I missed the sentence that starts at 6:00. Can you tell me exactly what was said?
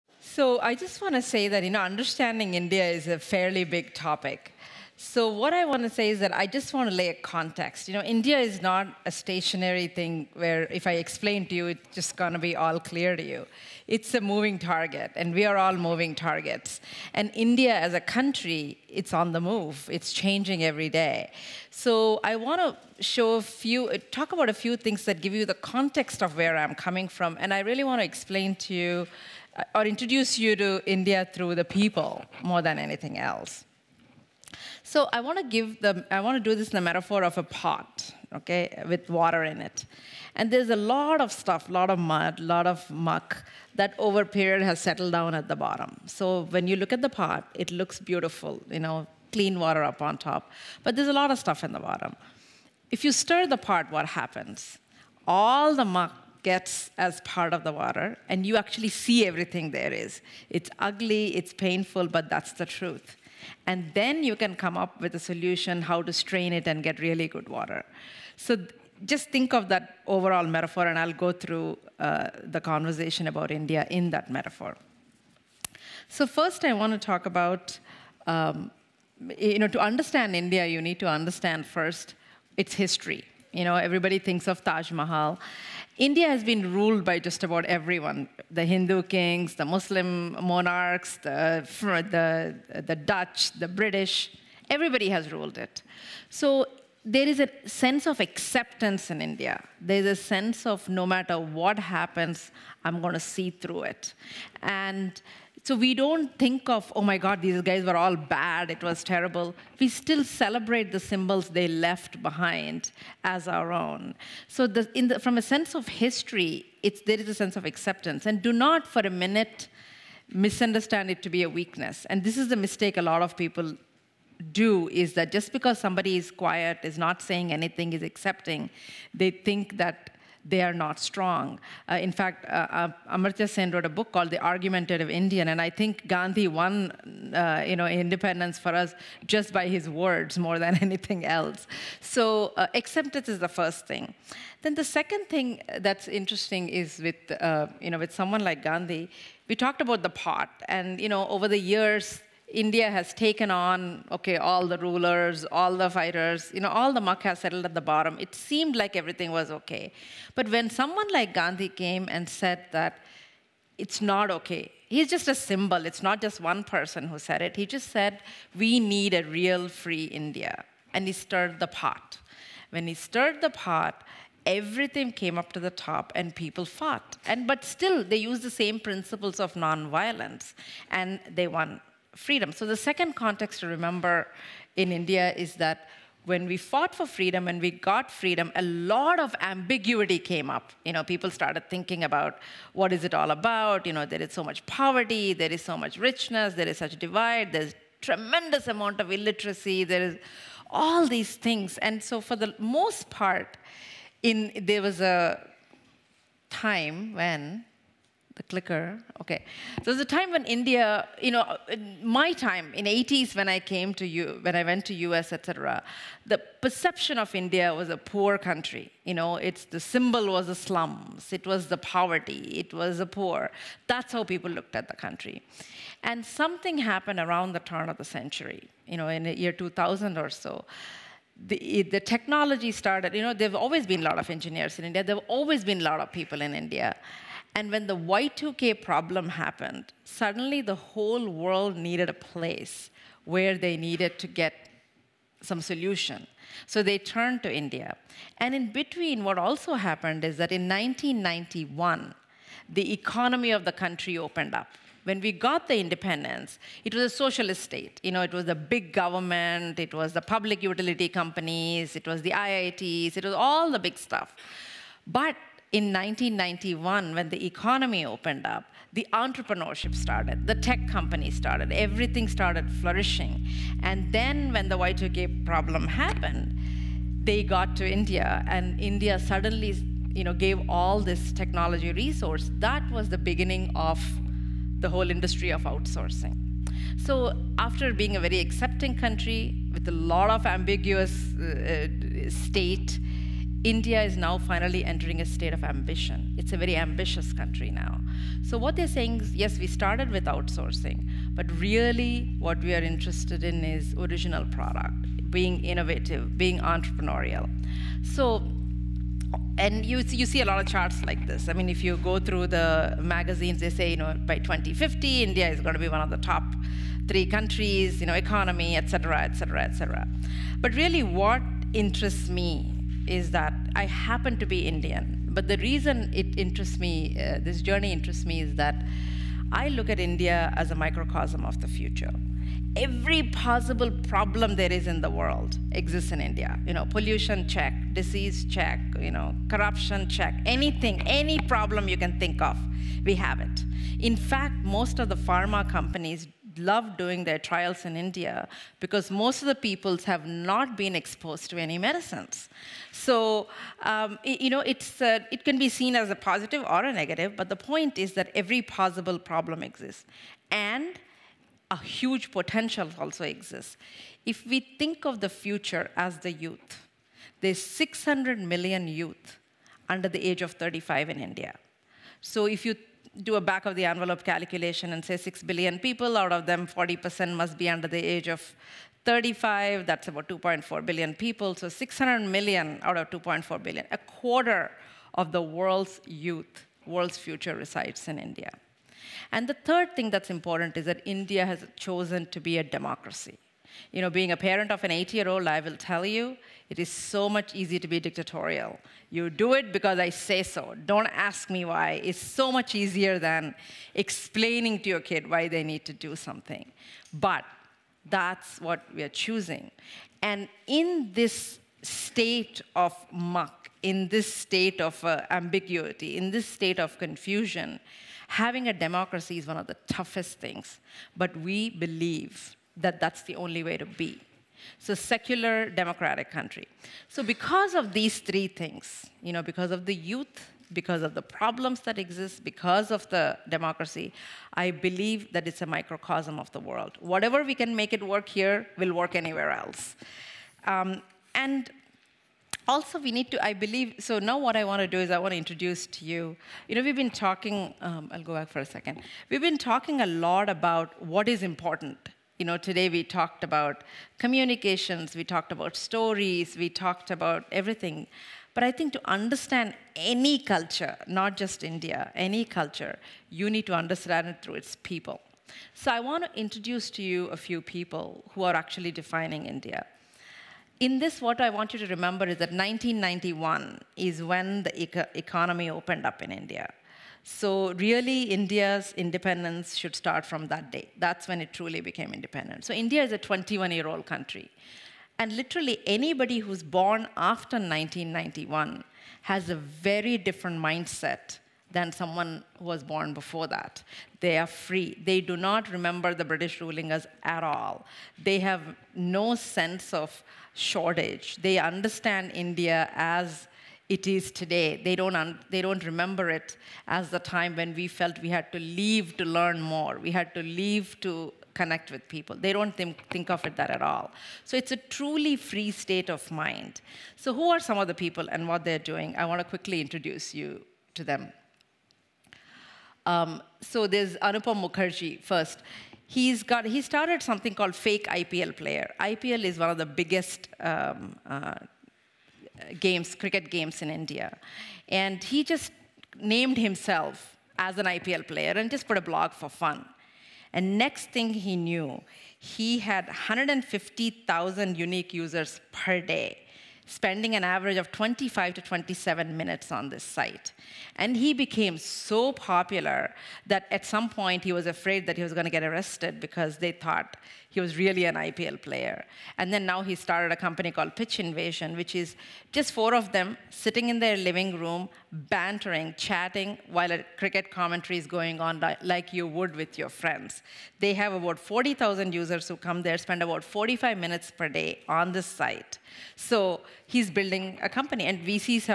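And a huge potential also exists.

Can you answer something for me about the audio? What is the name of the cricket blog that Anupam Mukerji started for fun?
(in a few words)
Fake IPL Player.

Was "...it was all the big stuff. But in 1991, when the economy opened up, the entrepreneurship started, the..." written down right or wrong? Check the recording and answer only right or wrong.
right.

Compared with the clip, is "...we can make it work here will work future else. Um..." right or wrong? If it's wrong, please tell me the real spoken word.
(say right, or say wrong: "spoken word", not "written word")
wrong: "anywhere", not "future".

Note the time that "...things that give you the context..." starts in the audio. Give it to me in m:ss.
0:24.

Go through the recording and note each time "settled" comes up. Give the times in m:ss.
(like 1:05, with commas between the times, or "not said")
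0:44, 2:37.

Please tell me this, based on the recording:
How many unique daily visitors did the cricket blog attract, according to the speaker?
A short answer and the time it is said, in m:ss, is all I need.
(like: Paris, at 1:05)
150,000, at 9:03.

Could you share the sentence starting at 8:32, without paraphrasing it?
They don't think, think of it that at all.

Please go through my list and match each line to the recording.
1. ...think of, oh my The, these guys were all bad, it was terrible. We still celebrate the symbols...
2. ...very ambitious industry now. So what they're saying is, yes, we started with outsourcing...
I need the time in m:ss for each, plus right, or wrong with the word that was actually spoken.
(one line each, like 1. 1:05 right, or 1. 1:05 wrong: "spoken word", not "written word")
1. 1:46 wrong: "God", not "The"
2. 4:56 wrong: "country", not "industry".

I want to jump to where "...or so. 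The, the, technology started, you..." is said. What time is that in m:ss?
3:50.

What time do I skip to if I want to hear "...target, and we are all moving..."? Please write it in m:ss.
0:14.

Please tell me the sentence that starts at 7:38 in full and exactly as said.
But I think to understand any culture, not just India, any culture, you need to understand it through its people.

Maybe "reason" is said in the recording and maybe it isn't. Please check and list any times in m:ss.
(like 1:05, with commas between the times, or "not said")
5:25.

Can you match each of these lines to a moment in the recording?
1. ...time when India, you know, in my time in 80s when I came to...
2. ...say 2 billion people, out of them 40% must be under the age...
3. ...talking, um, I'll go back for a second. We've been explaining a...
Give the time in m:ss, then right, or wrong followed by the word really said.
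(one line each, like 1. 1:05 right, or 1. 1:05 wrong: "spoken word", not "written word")
1. 3:30 right
2. 6:15 wrong: "6", not "2"
3. 7:27 wrong: "talking", not "explaining".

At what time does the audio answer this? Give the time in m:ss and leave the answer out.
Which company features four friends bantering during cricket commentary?
9:20.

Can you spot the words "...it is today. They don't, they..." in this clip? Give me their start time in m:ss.
8:23.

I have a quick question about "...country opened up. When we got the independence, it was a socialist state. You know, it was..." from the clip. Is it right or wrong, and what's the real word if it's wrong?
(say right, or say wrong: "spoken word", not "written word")
right.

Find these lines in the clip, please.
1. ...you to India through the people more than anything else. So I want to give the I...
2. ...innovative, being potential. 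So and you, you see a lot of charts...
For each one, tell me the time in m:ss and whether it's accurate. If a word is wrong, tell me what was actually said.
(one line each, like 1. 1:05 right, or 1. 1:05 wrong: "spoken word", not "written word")
1. 0:30 right
2. 5:05 wrong: "entrepreneurial", not "potential".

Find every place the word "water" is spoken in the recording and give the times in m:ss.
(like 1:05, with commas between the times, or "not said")
0:39, 0:49, 0:57, 1:07.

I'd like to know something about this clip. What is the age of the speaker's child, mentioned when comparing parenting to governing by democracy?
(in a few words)
8.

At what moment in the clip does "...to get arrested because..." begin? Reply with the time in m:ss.
9:15.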